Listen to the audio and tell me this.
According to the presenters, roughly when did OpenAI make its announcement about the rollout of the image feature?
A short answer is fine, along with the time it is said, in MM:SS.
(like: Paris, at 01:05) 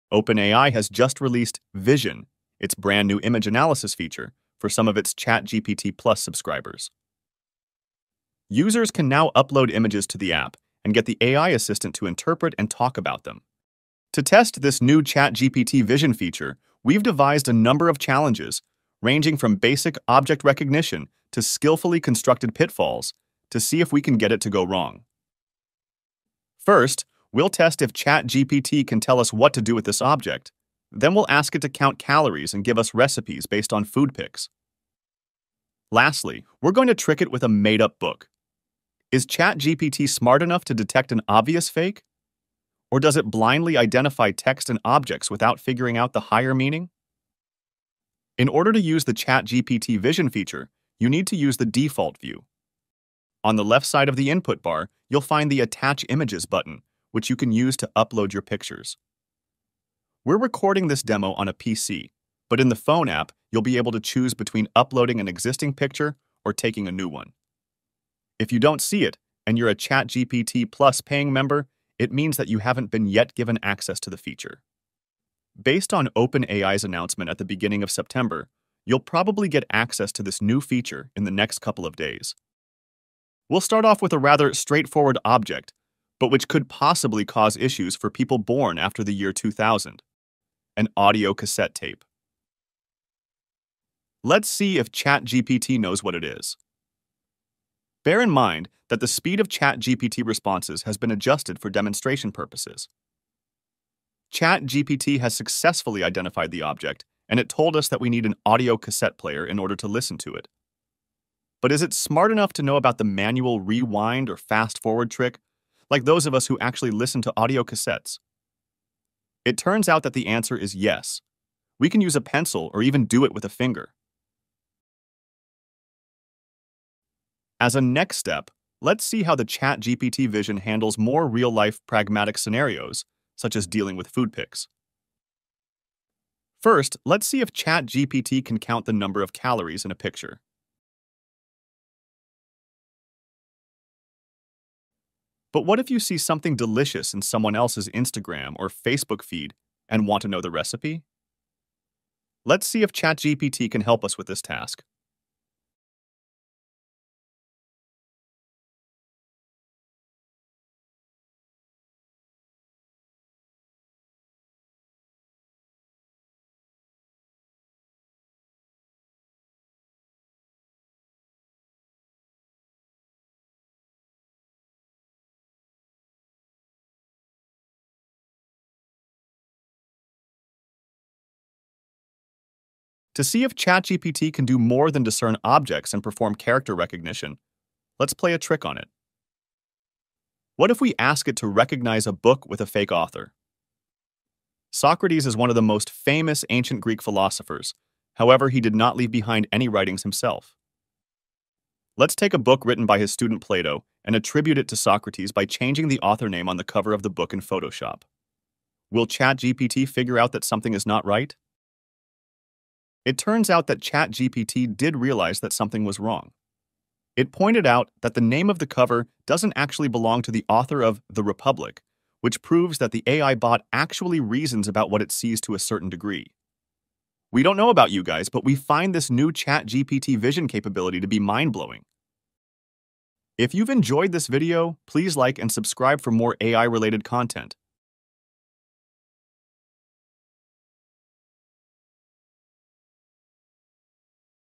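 beginning of September, at 01:17.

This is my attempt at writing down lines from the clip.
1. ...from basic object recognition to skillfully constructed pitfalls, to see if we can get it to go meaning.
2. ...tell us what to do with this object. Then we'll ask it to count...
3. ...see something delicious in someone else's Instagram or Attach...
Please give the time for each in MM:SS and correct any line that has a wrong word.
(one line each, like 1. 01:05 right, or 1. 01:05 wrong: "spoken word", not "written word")
1. 00:19 wrong: "wrong", not "meaning"
2. 00:28 right
3. 02:25 wrong: "Facebook", not "Attach".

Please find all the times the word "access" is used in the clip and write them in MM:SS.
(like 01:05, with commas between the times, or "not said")
01:13, 01:19.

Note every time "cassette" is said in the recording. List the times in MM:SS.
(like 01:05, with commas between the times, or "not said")
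01:31, 01:48, 01:57.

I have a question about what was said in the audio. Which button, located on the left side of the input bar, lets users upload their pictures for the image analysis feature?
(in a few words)
Attach Images.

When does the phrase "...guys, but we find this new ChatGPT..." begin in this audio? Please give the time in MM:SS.
03:48.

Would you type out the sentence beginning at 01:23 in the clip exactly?
We'll start off with a rather straightforward object but which could possibly cause issues for people born after the year 2000.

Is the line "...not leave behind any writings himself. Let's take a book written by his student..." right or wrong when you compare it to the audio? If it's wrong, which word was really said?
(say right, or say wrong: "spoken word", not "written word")
right.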